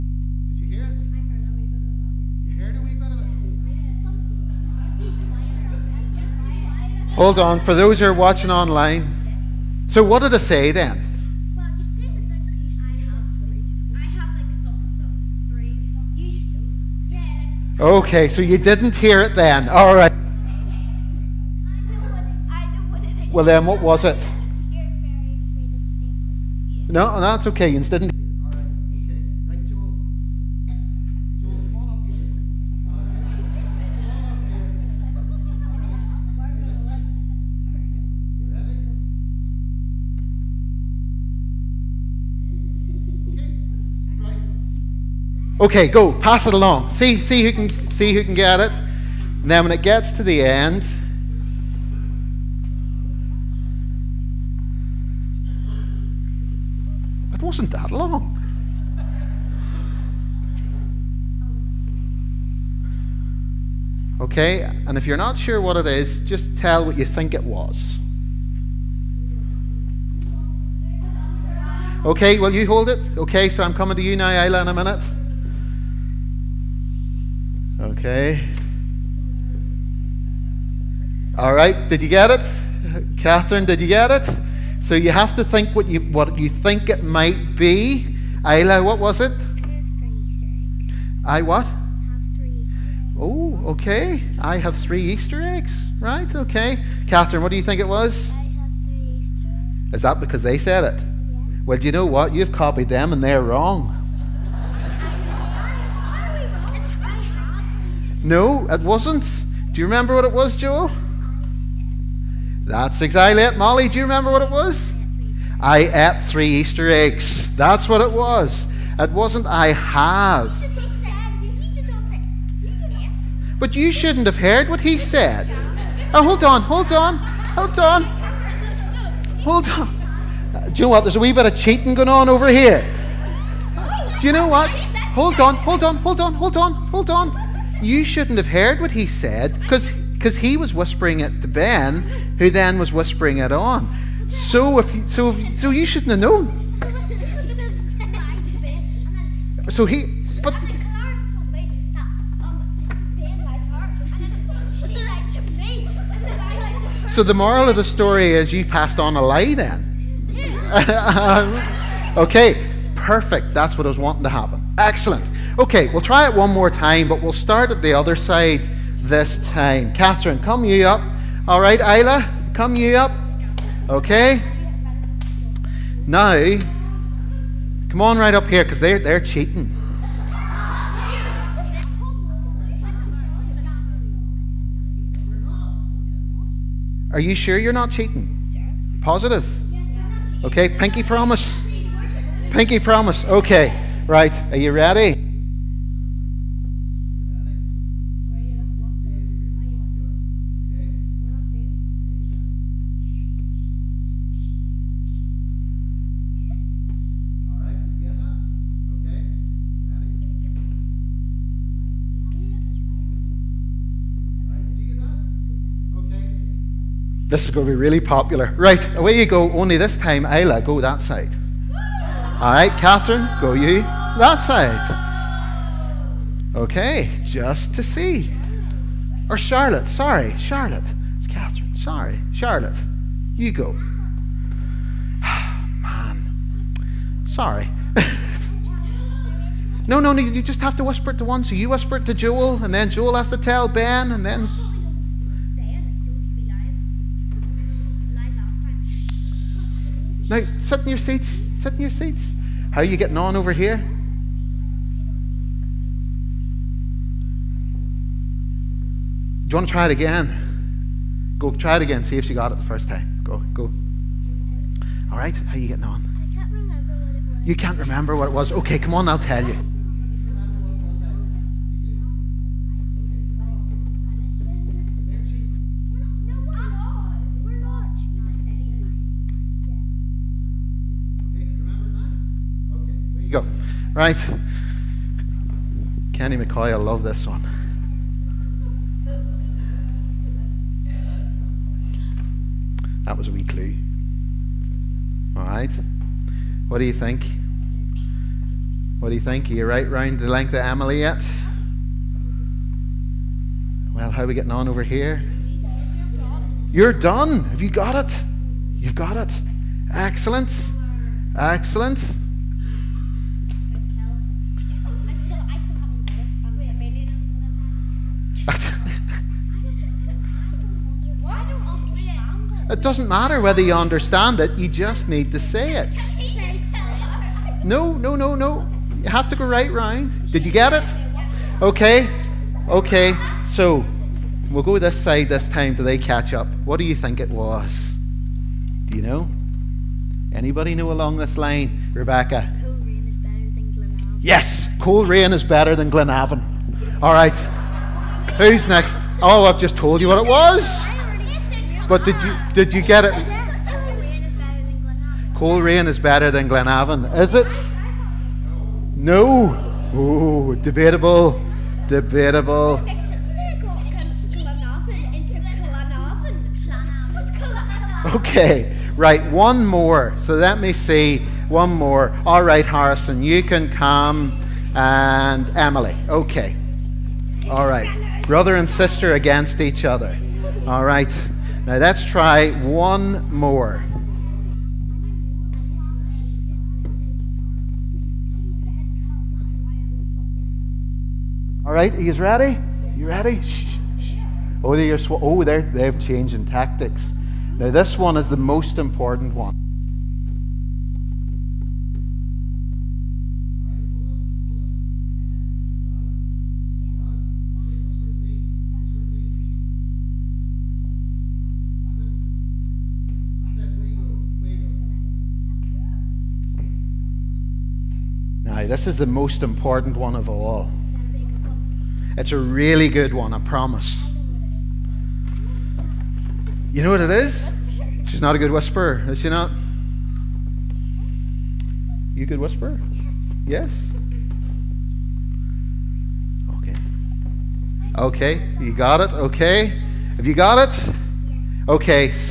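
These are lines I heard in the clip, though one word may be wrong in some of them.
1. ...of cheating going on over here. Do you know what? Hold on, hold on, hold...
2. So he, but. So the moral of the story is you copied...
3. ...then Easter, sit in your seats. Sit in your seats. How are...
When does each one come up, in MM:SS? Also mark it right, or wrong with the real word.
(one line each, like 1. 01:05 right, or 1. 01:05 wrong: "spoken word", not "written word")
1. 02:11 right
2. 02:29 wrong: "passed", not "copied"
3. 04:04 wrong: "Now", not "Easter".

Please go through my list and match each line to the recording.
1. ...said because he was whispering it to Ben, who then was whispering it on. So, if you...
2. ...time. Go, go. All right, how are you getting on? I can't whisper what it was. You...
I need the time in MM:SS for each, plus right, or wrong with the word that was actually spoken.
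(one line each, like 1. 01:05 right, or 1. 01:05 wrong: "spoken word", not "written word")
1. 02:19 right
2. 04:22 wrong: "remember", not "whisper".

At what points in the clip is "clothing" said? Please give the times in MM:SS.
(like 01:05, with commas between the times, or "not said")
not said.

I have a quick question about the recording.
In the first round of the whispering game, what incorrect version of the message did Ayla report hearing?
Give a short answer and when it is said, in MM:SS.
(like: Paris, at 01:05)
I have three Easter eggs, at 01:34.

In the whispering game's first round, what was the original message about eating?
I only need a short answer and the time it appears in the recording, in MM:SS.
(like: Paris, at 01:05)
I ate three Easter eggs, at 01:55.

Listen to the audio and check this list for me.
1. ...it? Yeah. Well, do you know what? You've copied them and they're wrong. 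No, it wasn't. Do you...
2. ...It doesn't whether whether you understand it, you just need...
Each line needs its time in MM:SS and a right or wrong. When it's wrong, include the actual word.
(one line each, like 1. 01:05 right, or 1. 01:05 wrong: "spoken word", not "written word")
1. 01:40 right
2. 05:22 wrong: "matter", not "whether".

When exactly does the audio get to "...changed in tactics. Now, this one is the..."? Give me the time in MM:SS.
06:35.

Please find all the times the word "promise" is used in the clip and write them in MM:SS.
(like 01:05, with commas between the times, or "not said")
03:11, 07:03.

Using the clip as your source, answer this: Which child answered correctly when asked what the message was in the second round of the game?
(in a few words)
Rebecca.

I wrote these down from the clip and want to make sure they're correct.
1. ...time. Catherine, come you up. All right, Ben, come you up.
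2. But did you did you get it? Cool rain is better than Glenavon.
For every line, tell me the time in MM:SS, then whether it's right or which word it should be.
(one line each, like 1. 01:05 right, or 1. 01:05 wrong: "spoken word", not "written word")
1. 02:49 wrong: "Isla", not "Ben"
2. 05:51 right.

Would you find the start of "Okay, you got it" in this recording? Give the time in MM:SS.
07:17.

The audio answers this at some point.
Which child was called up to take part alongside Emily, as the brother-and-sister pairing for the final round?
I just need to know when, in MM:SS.
06:12.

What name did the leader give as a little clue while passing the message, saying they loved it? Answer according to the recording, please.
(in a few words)
Kenny McCoy.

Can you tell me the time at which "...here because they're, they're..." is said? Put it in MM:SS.
02:58.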